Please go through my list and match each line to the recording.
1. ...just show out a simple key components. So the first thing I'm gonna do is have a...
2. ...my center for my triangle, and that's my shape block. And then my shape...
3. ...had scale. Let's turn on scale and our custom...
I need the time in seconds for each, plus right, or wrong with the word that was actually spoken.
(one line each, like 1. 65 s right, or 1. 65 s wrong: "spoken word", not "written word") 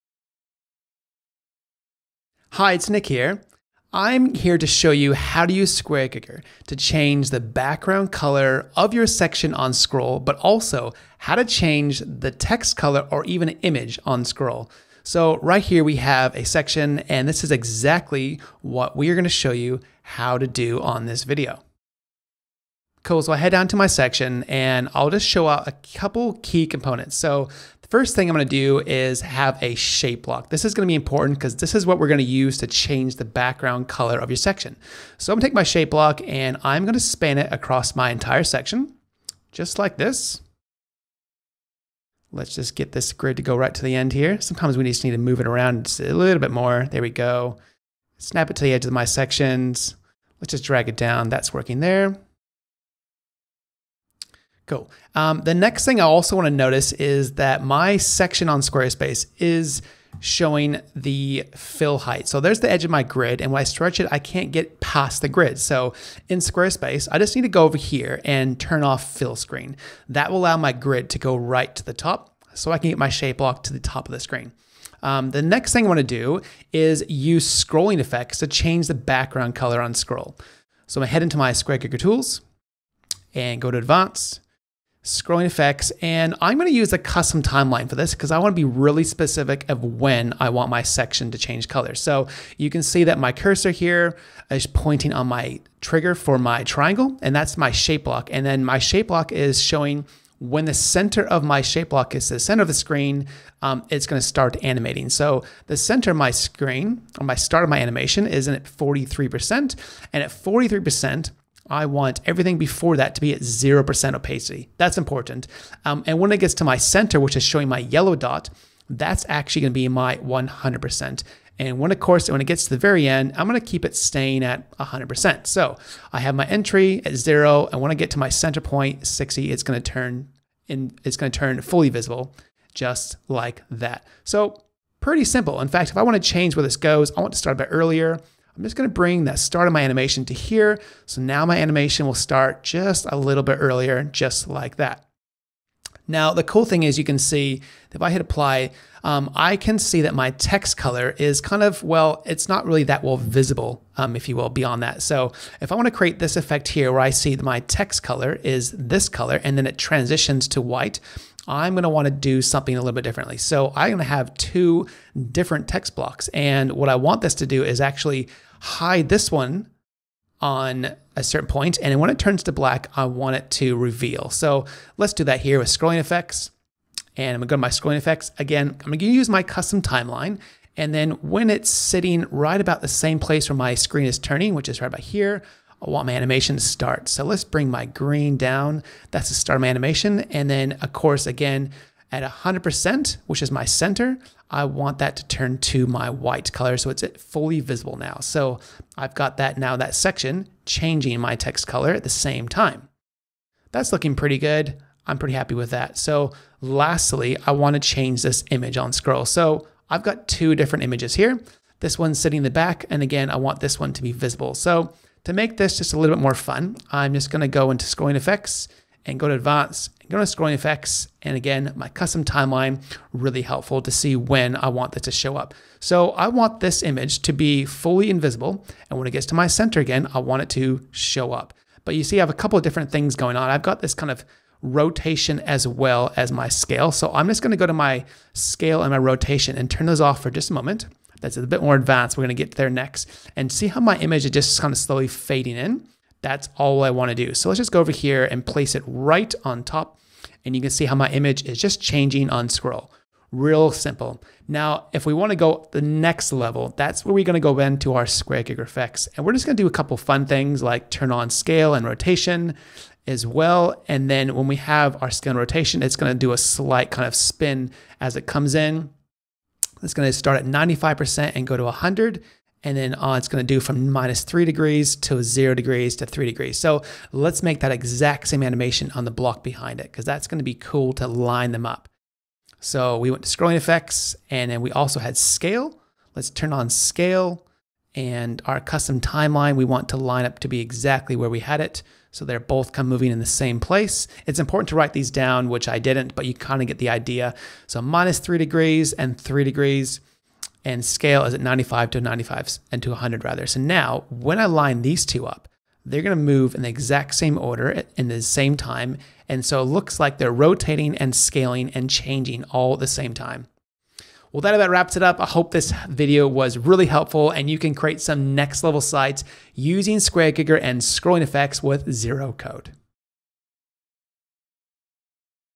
1. 25 s wrong: "couple", not "simple"
2. 95 s wrong: "trigger", not "center"
3. 284 s right.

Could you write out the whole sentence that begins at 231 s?
But you see, I have a couple of different things going on.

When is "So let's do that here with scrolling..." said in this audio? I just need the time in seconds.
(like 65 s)
174 s.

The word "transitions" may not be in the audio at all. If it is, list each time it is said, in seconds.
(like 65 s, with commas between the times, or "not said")
159 s.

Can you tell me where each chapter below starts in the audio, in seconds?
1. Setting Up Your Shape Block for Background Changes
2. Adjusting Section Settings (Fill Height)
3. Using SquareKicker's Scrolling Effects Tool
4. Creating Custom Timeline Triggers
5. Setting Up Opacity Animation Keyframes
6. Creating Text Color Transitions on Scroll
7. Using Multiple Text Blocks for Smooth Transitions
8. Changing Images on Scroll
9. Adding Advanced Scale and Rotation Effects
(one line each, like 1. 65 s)
1. 23 s
2. 55 s
3. 75 s
4. 91 s
5. 105 s
6. 151 s
7. 178 s
8. 208 s
9. 223 s.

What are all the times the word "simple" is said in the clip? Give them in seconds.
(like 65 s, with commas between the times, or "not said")
135 s, 253 s.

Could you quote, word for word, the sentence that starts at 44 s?
Sometimes we just need to move it around a little bit more.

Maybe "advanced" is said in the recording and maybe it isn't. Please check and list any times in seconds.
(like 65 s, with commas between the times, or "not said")
83 s, 219 s, 241 s.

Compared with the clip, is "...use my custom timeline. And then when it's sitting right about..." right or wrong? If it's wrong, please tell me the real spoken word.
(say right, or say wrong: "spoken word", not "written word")
right.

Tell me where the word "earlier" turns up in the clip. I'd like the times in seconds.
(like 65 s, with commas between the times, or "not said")
137 s, 143 s.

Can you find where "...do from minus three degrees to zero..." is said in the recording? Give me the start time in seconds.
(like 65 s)
273 s.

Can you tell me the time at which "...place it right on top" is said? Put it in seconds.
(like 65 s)
248 s.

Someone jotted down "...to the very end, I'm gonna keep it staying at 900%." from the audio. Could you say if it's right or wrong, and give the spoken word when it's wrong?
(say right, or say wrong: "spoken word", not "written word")
wrong: "100", not "900".